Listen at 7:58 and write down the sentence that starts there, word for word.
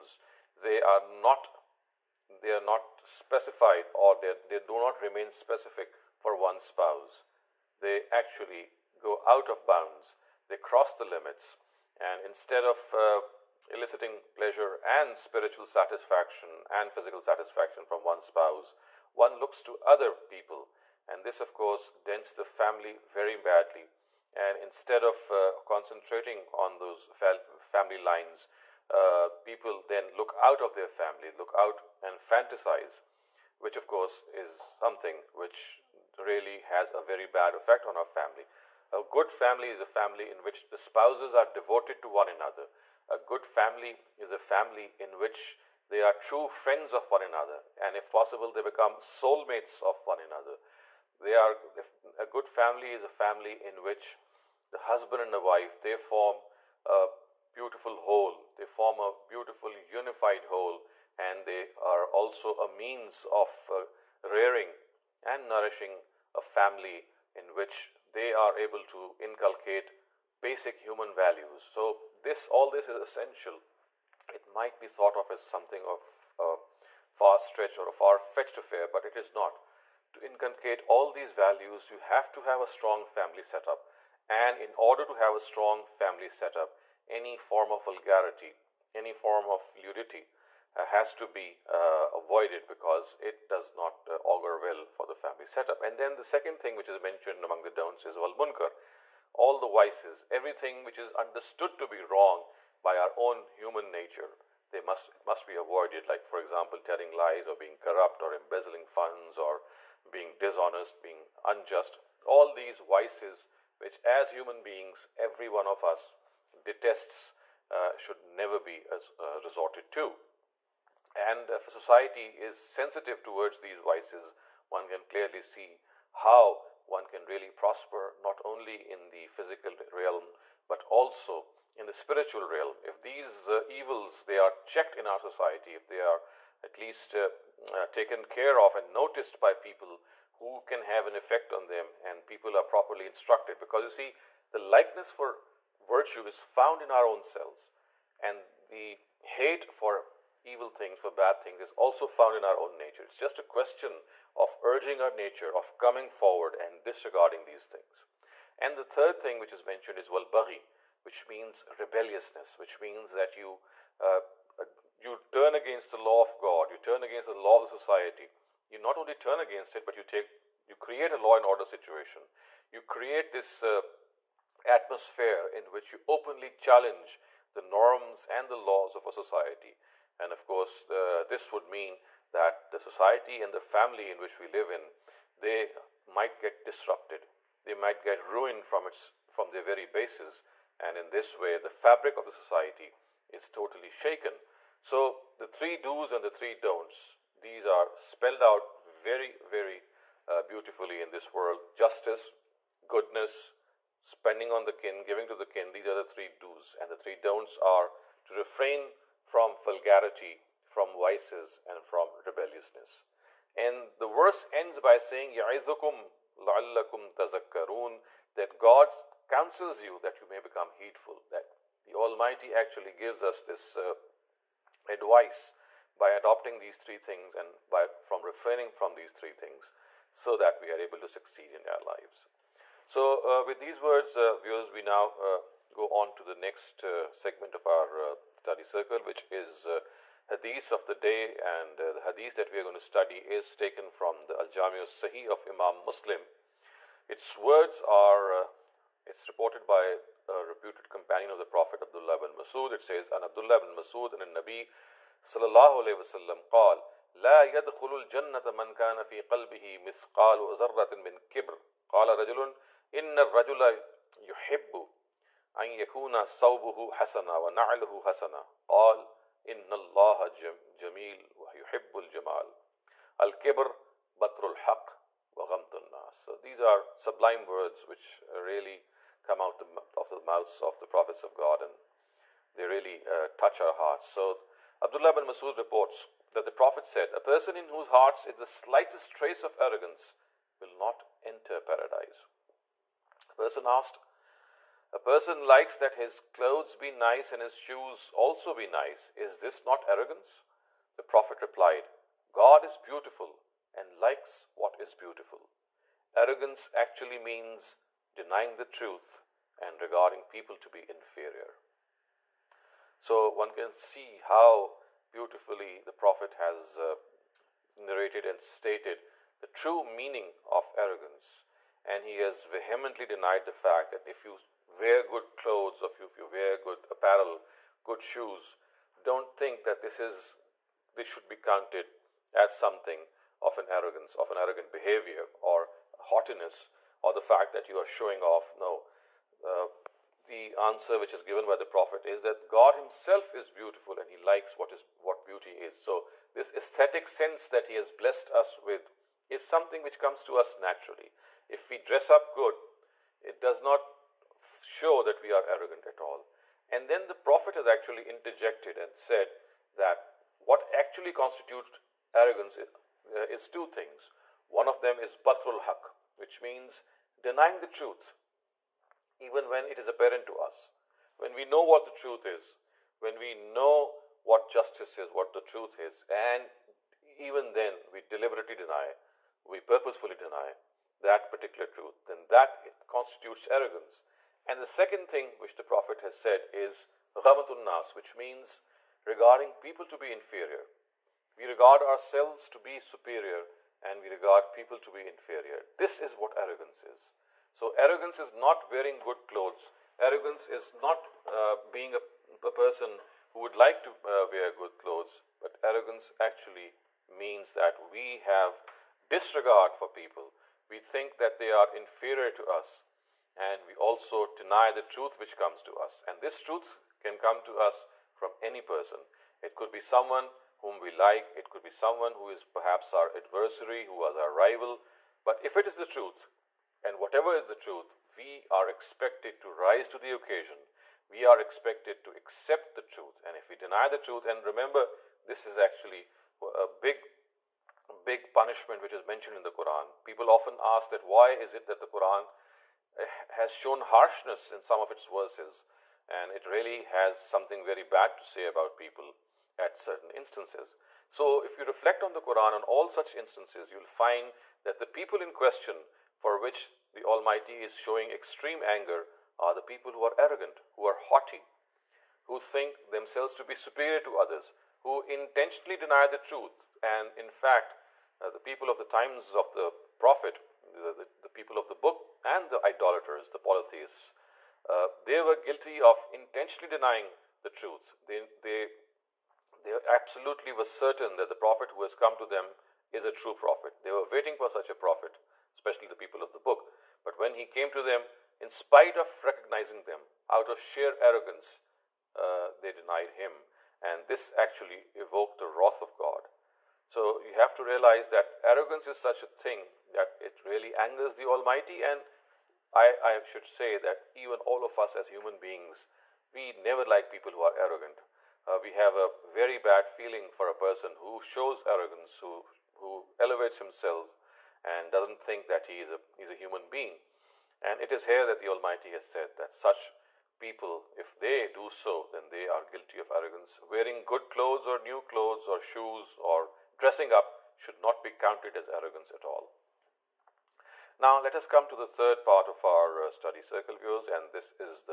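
They, they they absolutely were certain that the prophet who has come to them is a true prophet.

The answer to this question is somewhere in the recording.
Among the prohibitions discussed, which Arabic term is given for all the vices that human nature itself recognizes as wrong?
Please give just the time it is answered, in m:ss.
1:38.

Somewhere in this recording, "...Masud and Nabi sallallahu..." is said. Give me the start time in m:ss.
4:13.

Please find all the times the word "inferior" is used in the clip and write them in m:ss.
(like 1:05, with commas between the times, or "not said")
5:10, 6:30, 6:35, 6:51.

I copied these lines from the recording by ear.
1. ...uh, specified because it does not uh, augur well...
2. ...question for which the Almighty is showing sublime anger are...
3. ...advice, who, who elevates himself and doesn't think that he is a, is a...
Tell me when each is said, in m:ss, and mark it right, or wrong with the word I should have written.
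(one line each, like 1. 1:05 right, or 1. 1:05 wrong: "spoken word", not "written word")
1. 1:31 wrong: "avoided", not "specified"
2. 7:35 wrong: "extreme", not "sublime"
3. 8:31 wrong: "arrogance", not "advice".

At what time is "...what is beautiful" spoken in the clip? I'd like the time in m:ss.
5:04.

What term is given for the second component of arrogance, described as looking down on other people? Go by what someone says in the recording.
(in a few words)
ghamatun nas.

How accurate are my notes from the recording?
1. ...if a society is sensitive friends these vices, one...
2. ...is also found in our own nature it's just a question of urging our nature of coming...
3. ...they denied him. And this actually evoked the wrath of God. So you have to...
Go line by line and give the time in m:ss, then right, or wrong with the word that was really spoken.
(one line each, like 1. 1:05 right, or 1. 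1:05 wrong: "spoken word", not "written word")
1. 2:01 wrong: "towards", not "friends"
2. 2:31 right
3. 8:12 right.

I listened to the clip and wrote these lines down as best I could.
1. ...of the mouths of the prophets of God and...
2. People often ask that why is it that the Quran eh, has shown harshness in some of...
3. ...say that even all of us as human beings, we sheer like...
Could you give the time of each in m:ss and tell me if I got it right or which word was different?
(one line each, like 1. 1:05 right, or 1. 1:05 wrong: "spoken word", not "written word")
1. 4:39 right
2. 7:20 right
3. 8:23 wrong: "never", not "sheer".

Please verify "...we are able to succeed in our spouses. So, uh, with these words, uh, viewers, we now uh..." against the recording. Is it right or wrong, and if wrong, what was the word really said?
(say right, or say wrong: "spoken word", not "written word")
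wrong: "lives", not "spouses".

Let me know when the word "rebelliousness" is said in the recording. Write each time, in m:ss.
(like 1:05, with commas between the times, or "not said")
2:41, 3:32.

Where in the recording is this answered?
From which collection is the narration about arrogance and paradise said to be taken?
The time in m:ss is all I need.
4:04.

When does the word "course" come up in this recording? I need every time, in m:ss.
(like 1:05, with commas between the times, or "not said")
0:21, 0:33, 3:00.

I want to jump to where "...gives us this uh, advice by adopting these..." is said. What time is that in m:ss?
3:42.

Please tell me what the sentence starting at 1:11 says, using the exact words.
So this, all this is essential.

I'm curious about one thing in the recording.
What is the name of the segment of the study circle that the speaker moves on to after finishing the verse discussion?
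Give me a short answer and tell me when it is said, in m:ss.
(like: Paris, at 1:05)
Hadith of the day, at 4:00.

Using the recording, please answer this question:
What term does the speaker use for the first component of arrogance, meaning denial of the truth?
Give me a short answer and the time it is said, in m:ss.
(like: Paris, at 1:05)
batrul haq, at 6:05.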